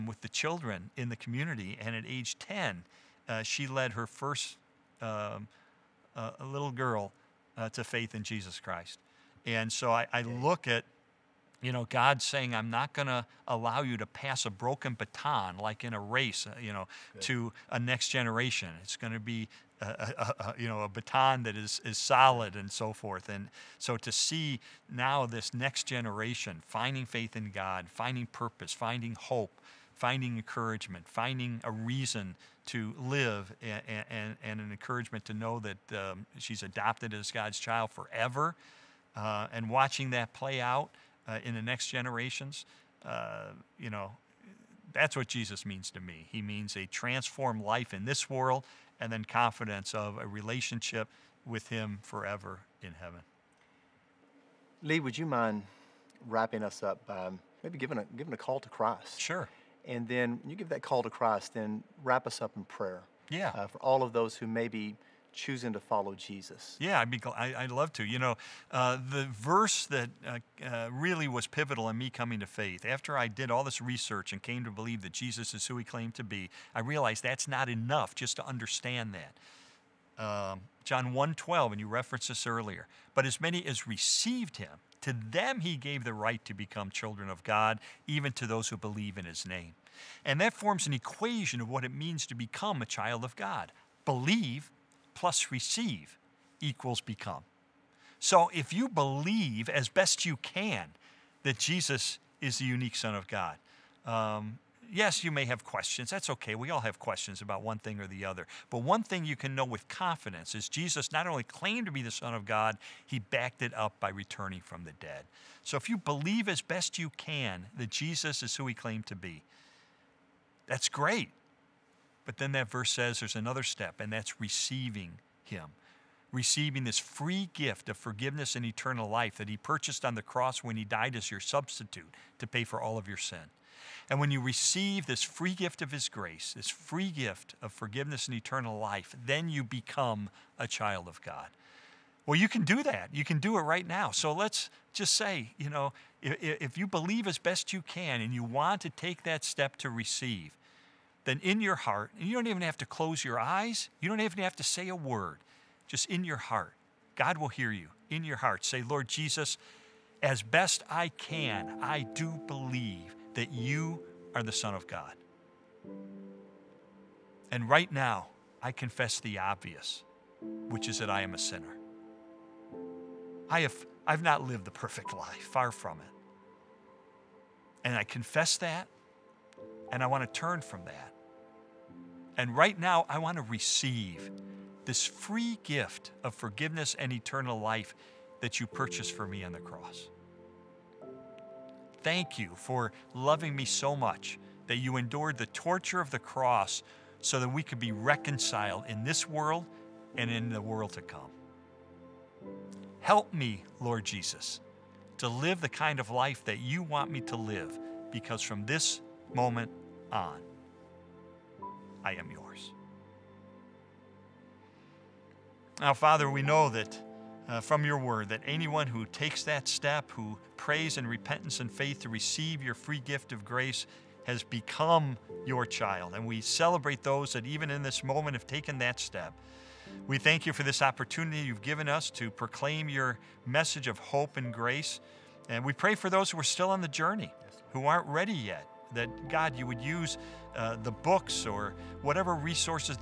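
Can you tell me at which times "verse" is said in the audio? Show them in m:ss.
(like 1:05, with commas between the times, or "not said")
1:09, 2:02.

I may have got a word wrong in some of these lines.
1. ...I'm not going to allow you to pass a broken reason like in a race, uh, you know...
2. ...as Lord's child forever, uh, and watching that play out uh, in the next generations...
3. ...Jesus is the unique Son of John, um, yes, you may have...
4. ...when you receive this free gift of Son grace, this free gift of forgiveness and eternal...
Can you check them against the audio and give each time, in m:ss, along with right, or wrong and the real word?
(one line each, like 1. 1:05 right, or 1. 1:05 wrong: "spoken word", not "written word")
1. 0:12 wrong: "baton", not "reason"
2. 0:37 wrong: "God", not "Lord"
3. 1:41 wrong: "God", not "John"
4. 2:14 wrong: "His", not "Son".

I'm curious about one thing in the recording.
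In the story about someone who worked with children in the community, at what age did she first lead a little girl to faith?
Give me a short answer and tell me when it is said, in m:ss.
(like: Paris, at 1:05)
10, at 0:02.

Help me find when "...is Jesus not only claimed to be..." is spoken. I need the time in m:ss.
1:50.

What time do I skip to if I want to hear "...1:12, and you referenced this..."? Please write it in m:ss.
1:21.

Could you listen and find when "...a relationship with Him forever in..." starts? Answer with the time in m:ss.
0:50.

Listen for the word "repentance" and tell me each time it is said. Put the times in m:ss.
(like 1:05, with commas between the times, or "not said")
3:41.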